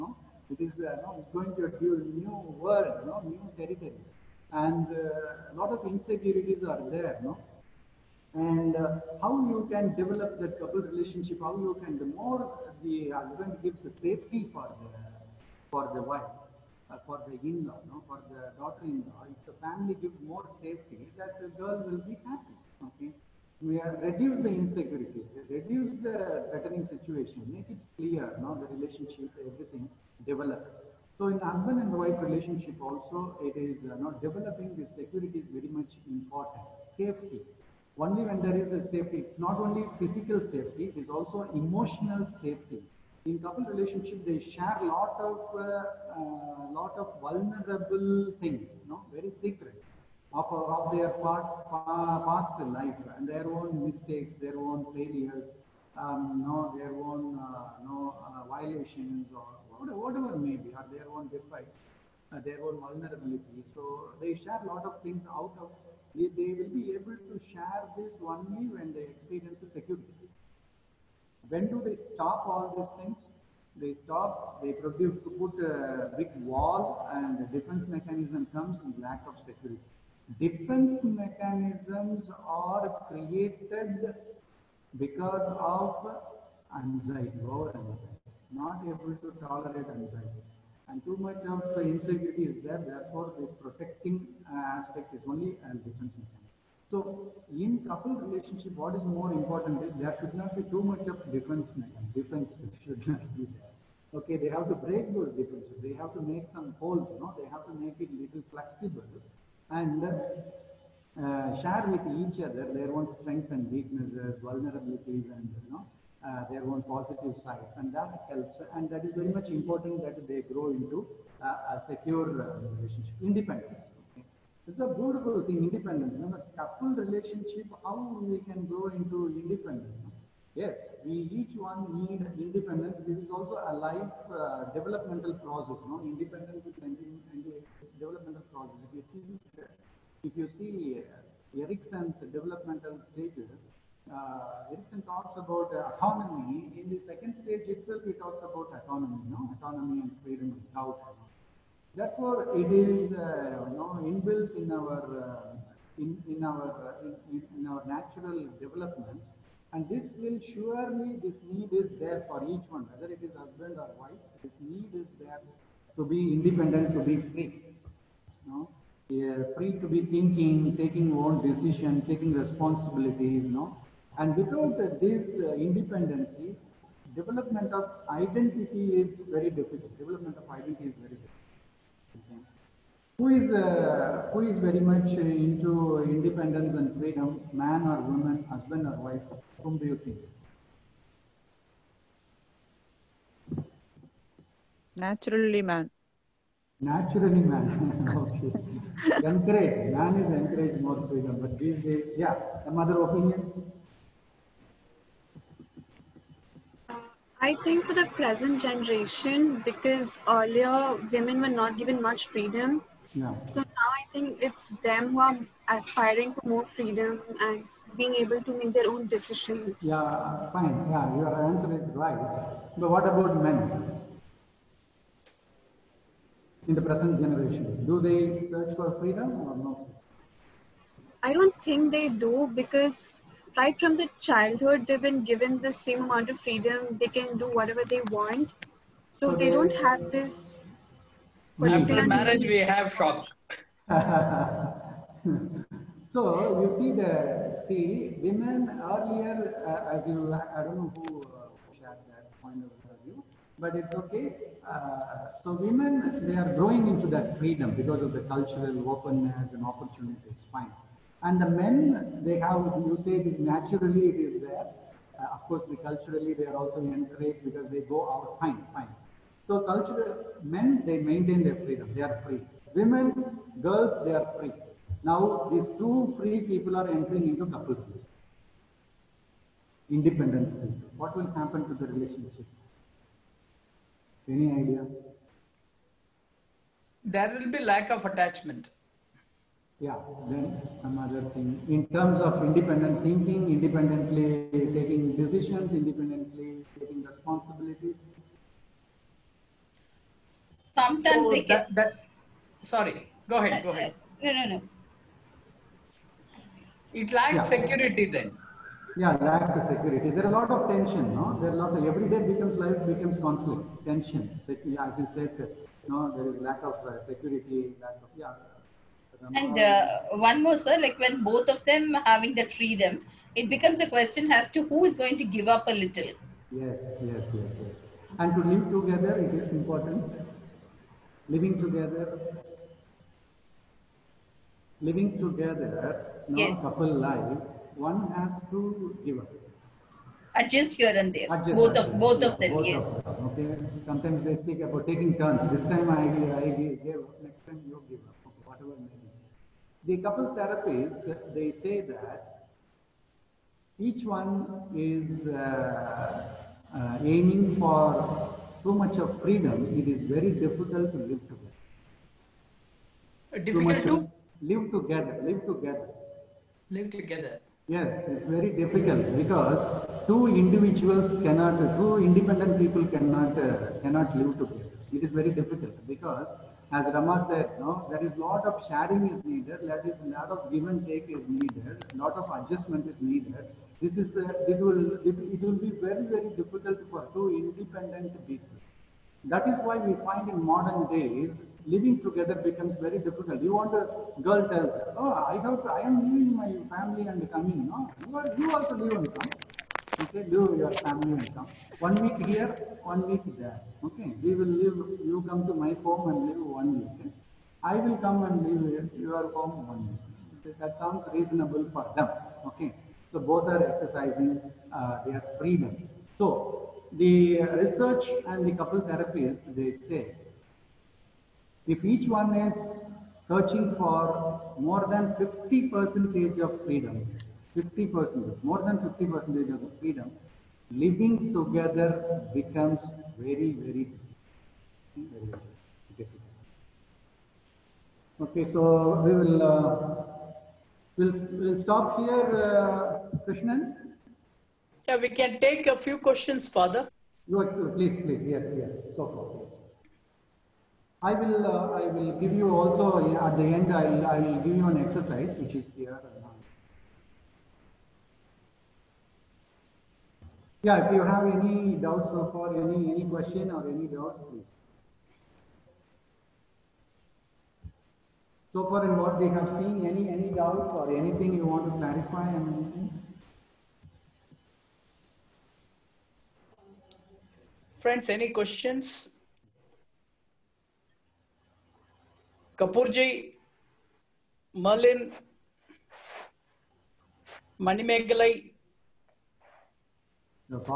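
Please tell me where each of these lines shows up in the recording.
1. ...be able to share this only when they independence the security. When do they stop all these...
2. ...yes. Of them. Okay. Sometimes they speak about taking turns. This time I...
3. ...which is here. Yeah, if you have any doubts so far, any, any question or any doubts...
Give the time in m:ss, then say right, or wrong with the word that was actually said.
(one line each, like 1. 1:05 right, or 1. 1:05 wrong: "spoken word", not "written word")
1. 1:06 wrong: "experience", not "independence"
2. 5:42 right
3. 7:35 right.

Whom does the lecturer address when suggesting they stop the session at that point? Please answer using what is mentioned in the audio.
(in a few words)
Krishnan.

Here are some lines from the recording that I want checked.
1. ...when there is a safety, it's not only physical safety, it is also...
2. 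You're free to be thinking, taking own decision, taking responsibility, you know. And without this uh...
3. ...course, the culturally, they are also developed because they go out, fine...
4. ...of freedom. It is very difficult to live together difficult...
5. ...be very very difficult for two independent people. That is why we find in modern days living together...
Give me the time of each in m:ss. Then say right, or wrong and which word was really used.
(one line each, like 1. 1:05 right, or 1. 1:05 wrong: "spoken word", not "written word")
1. 0:38 right
2. 2:49 right
3. 4:25 wrong: "encouraged", not "developed"
4. 5:58 right
5. 6:25 right.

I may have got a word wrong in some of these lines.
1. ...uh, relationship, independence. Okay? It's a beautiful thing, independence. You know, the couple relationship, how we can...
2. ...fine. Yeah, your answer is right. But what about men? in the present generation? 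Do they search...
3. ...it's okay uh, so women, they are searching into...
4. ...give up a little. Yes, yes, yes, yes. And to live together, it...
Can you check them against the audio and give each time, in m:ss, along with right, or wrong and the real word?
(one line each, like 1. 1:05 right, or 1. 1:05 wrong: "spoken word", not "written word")
1. 2:02 right
2. 3:40 right
3. 4:13 wrong: "growing", not "searching"
4. 5:25 right.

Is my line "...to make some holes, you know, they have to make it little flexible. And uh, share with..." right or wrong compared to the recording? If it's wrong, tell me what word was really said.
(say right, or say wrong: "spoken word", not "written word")
right.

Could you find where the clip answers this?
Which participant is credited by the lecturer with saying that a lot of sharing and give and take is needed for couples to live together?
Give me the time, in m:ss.
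6:16.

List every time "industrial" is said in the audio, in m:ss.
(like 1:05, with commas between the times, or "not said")
not said.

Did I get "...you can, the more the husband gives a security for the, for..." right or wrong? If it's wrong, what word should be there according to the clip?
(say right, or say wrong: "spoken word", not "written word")
wrong: "safety", not "security".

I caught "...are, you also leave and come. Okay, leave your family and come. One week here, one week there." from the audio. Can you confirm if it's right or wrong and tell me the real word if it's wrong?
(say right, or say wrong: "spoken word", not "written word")
right.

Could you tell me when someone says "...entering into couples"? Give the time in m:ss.
4:36.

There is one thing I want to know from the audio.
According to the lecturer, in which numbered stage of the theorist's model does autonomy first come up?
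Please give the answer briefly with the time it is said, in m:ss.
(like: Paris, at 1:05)
Second stage, at 2:26.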